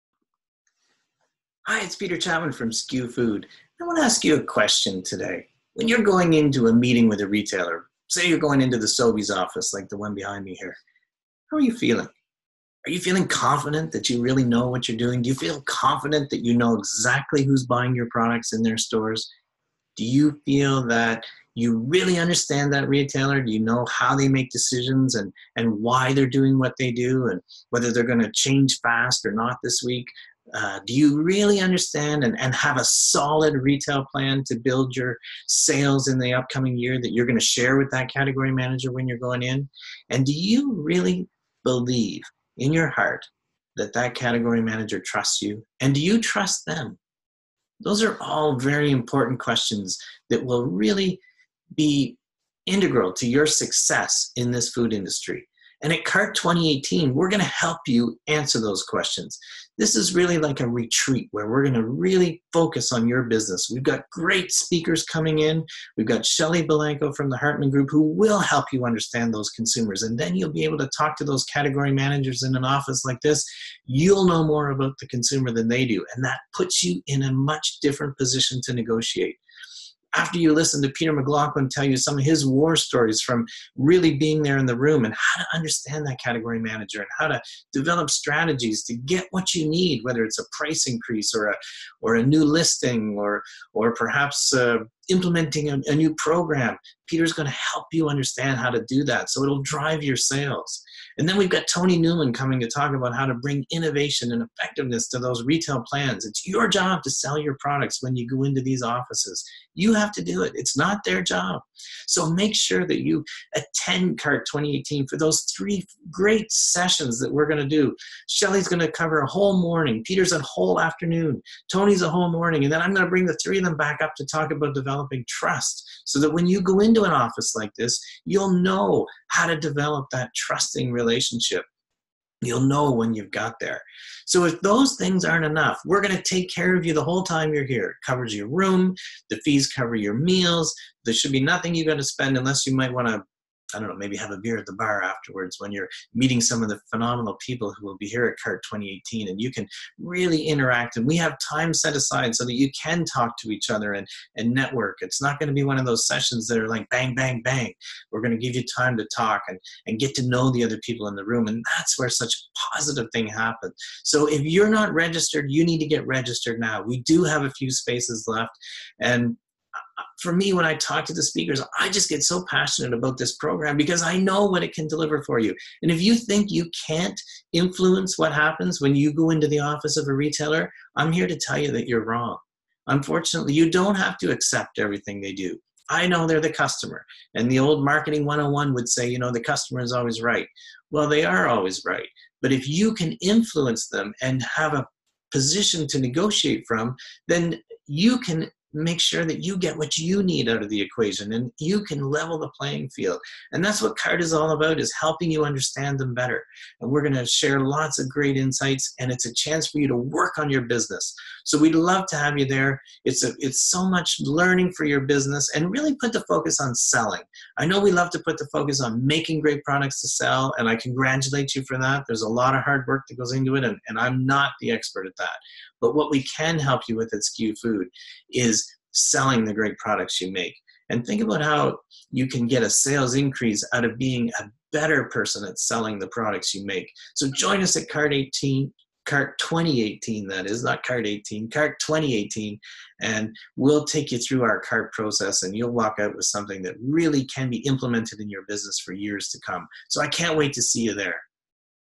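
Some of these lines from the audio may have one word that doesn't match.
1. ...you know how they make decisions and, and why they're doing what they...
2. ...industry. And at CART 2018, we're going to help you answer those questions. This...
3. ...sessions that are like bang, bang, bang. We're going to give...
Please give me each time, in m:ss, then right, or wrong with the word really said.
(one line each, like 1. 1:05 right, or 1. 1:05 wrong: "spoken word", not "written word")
1. 0:23 right
2. 0:54 right
3. 2:36 right.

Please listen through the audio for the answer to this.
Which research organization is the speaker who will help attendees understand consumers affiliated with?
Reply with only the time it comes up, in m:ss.
1:07.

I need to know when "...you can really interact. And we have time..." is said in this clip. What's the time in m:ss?
2:29.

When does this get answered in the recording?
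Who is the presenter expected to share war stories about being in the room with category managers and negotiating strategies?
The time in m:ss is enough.
1:20.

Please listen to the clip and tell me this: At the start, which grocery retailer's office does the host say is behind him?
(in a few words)
Sobeys.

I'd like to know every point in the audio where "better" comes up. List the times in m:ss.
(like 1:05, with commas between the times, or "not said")
3:26, 3:54.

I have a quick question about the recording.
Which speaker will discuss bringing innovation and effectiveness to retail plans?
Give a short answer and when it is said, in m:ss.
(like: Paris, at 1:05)
Tony Newman, at 1:41.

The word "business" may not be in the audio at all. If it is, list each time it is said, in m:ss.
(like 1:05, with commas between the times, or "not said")
1:03, 3:30, 3:35, 4:08.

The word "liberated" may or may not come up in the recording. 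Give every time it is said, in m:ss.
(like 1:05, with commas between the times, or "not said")
not said.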